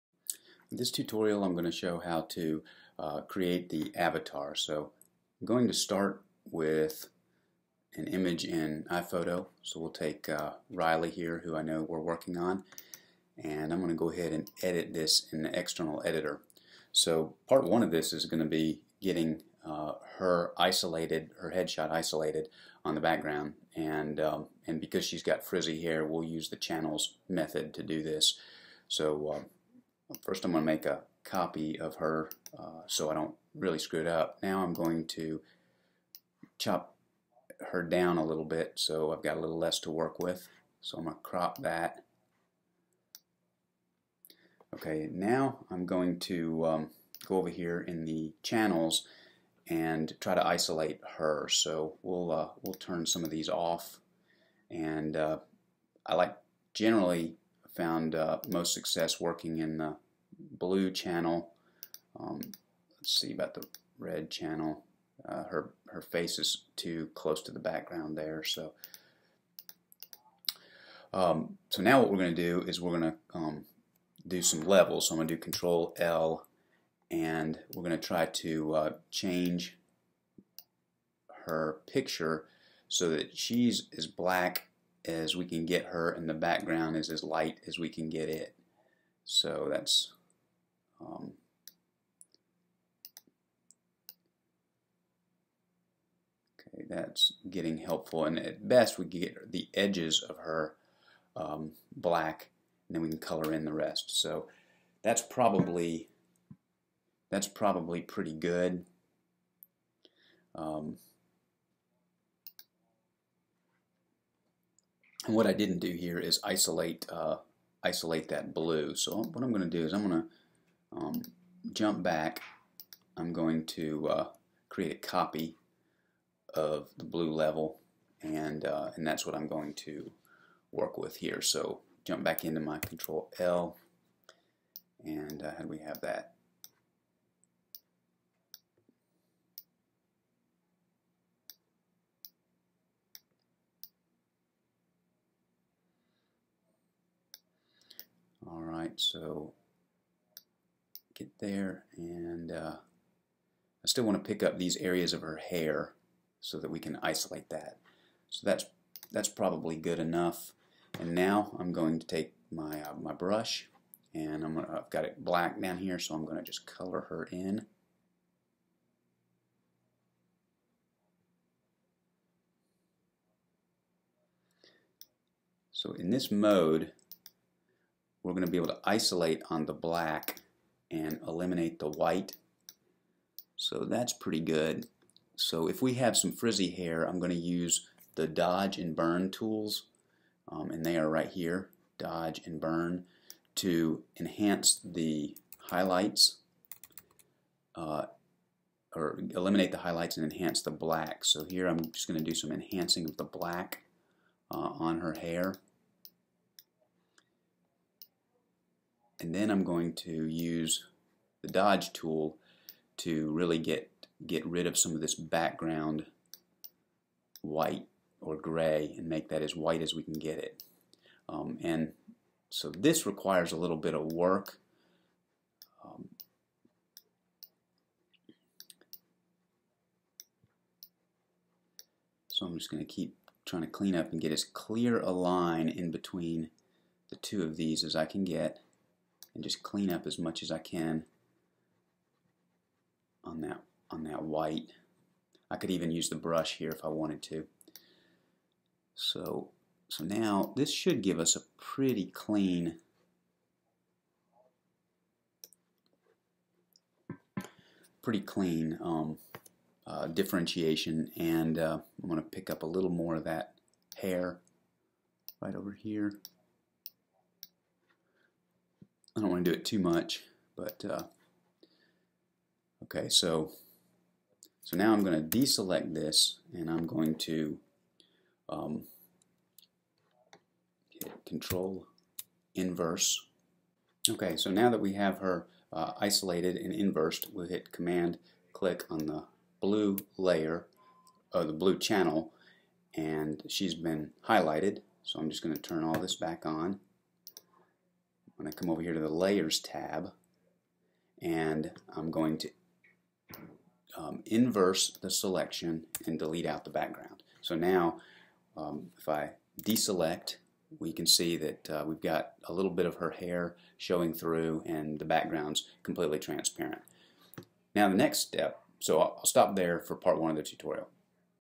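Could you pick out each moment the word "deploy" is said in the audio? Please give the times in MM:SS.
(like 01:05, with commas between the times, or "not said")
not said.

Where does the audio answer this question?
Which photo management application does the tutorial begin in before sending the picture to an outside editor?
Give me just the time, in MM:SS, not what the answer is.
00:08.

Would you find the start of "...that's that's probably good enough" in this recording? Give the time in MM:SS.
02:38.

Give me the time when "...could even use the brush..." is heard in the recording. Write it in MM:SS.
04:05.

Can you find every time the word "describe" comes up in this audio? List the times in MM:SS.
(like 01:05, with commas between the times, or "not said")
not said.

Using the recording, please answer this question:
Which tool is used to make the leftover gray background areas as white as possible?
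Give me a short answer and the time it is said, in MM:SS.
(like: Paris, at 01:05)
Dodge tool, at 03:31.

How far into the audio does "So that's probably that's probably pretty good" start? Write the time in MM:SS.
01:44.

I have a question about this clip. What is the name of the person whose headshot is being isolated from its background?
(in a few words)
Riley.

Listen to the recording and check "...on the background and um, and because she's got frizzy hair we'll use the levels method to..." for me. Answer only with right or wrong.
wrong.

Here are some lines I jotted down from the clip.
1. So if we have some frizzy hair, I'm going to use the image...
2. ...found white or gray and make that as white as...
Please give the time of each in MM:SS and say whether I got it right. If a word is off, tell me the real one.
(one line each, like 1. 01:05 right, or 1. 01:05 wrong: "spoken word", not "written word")
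1. 03:05 wrong: "dodge", not "image"
2. 03:35 wrong: "background", not "found".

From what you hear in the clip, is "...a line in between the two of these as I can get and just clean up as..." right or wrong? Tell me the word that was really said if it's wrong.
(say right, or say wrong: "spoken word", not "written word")
right.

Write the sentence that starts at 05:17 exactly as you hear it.
Now the next step, so I'll, I'll stop there for part one of the tutorial.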